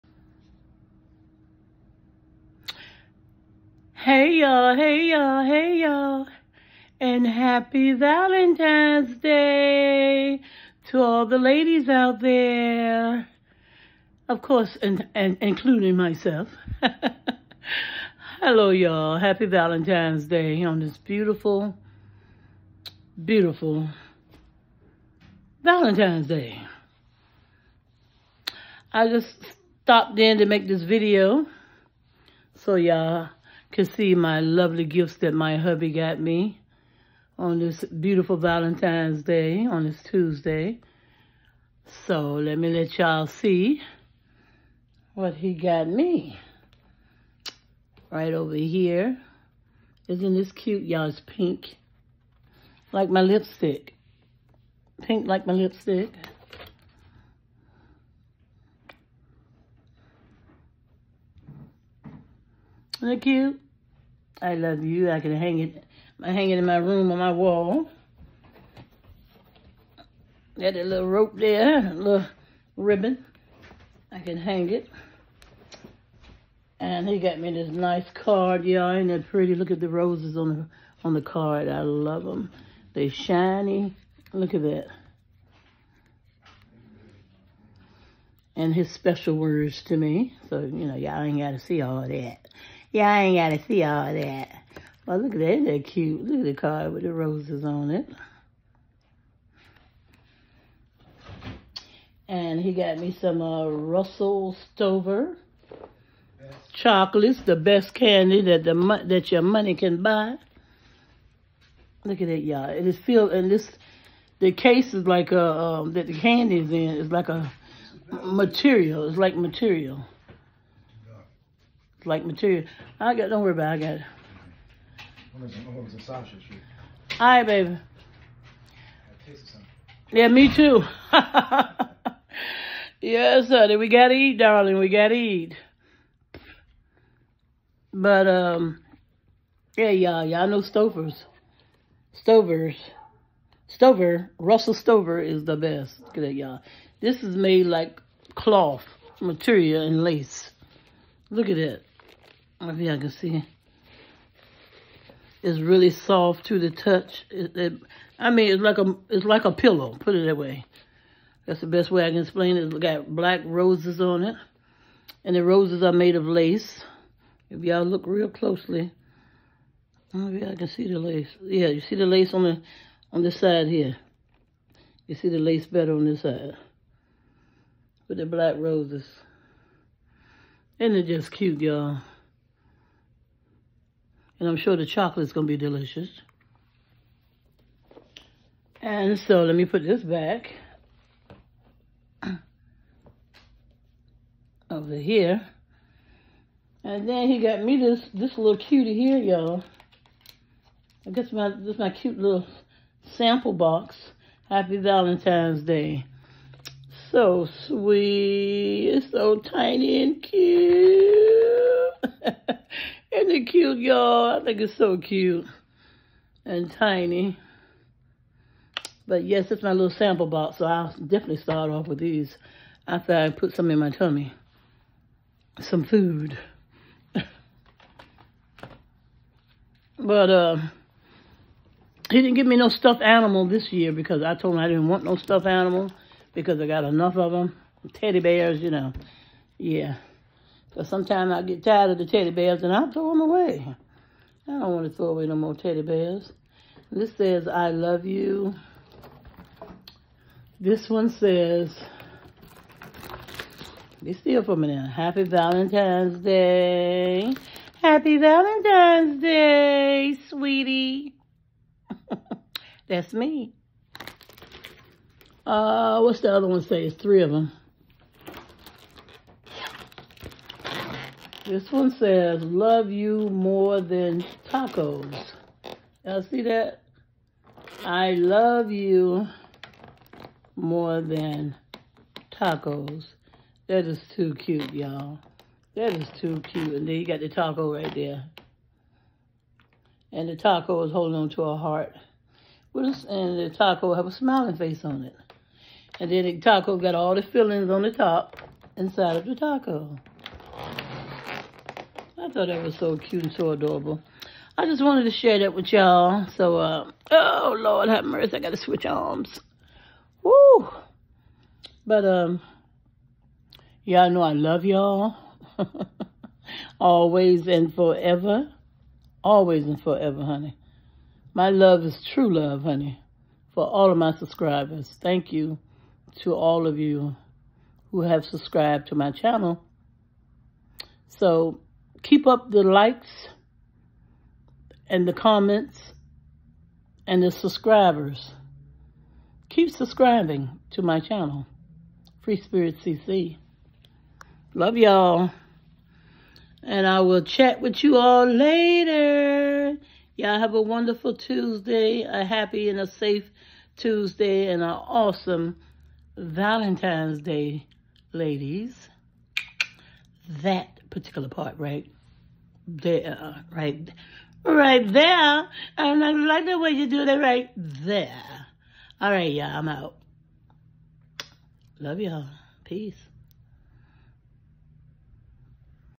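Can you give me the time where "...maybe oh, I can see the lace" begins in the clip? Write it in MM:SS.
02:50.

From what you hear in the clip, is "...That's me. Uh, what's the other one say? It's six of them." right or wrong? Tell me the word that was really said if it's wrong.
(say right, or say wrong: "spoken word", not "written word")
wrong: "three", not "six".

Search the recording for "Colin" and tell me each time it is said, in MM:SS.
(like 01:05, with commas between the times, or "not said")
not said.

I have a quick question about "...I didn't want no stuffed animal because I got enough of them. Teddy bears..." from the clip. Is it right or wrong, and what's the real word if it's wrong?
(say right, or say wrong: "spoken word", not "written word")
right.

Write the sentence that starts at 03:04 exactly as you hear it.
And I'm sure the chocolate is going to be delicious.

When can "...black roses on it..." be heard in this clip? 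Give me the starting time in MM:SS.
02:43.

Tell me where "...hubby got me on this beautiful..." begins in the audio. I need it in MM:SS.
00:35.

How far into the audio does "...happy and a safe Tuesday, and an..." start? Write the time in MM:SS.
05:52.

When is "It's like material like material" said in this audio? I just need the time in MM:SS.
01:59.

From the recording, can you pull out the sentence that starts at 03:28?
It's so tiny and cute it cute, y'all?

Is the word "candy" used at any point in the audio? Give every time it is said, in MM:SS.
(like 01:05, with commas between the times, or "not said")
01:47, 01:56.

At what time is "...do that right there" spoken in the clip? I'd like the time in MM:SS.
06:06.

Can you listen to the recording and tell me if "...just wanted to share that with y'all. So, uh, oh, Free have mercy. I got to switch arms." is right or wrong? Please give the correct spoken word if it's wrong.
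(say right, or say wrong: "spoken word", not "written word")
wrong: "Lord", not "Free".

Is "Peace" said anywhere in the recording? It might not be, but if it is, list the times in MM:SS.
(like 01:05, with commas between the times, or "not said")
06:12.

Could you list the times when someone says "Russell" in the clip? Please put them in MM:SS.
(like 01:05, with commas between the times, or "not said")
01:43, 02:24.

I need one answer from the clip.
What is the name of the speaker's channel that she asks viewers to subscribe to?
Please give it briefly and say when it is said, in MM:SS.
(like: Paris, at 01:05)
Free Spirit CC, at 05:42.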